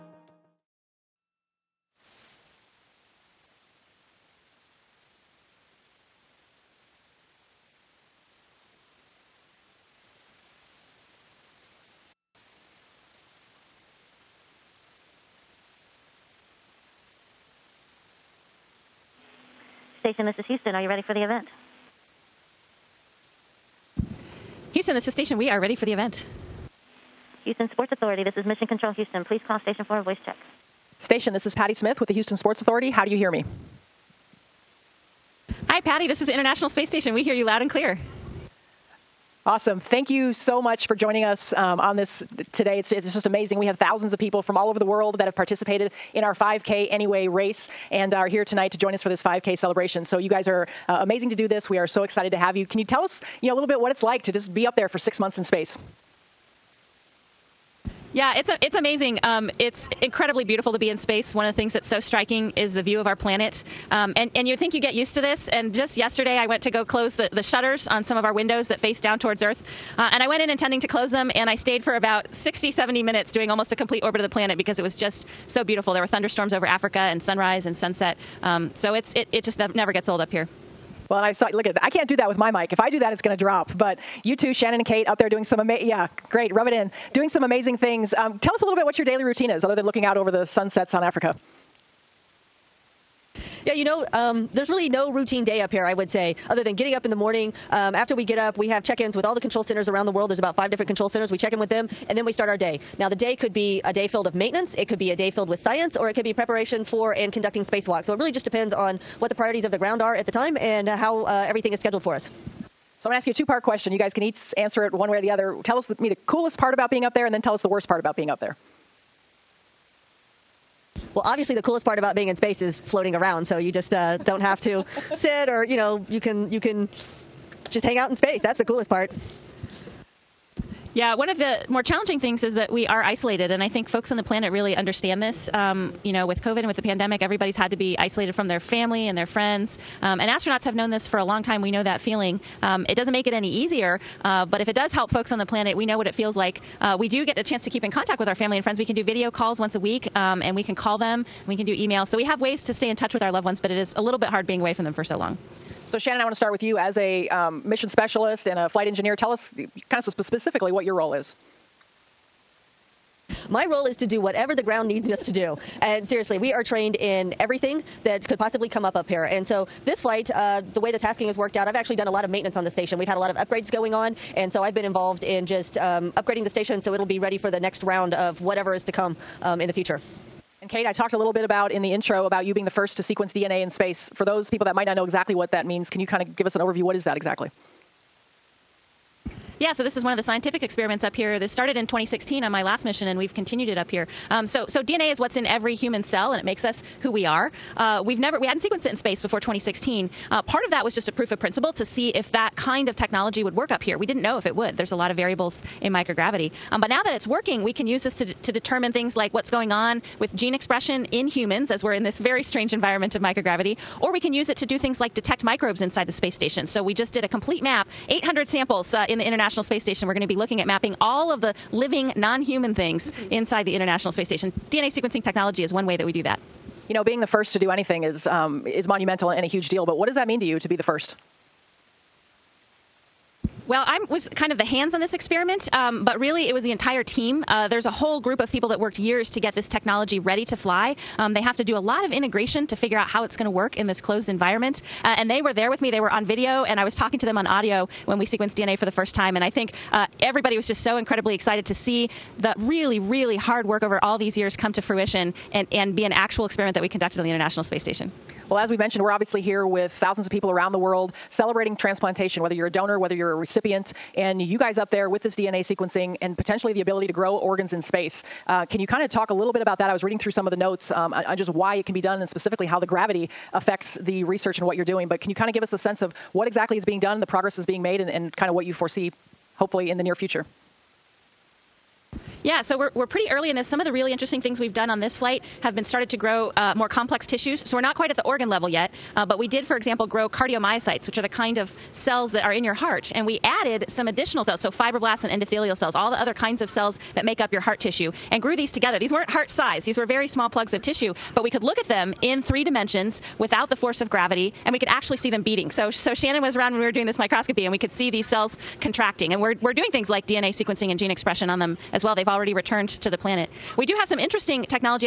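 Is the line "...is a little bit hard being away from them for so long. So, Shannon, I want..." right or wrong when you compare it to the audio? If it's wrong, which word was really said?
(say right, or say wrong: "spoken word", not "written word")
right.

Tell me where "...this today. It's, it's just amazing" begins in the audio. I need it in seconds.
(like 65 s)
41 s.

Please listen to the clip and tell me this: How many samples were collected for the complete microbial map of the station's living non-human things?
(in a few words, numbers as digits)
800.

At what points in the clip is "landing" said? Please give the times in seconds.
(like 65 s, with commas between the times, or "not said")
not said.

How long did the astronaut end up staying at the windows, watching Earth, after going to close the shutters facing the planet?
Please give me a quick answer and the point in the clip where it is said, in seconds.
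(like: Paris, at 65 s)
60 to 70 minutes, at 72 s.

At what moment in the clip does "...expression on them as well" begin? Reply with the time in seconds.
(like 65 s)
311 s.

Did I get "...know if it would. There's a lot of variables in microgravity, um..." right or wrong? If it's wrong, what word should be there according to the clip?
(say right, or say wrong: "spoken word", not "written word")
right.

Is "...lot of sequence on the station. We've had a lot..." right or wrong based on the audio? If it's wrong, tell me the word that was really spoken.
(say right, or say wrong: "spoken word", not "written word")
wrong: "maintenance", not "sequence".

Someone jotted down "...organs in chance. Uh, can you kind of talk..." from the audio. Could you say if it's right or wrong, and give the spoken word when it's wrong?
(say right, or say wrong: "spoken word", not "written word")
wrong: "space", not "chance".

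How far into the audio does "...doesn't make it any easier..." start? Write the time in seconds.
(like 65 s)
142 s.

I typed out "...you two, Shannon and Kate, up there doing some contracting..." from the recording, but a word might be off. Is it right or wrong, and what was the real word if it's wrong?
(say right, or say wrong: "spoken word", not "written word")
wrong: "amazing", not "contracting".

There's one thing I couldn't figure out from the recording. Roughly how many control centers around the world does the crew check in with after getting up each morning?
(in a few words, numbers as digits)
5.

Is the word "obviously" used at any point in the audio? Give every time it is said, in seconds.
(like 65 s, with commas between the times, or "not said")
121 s, 259 s.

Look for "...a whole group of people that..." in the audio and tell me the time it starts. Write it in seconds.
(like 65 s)
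237 s.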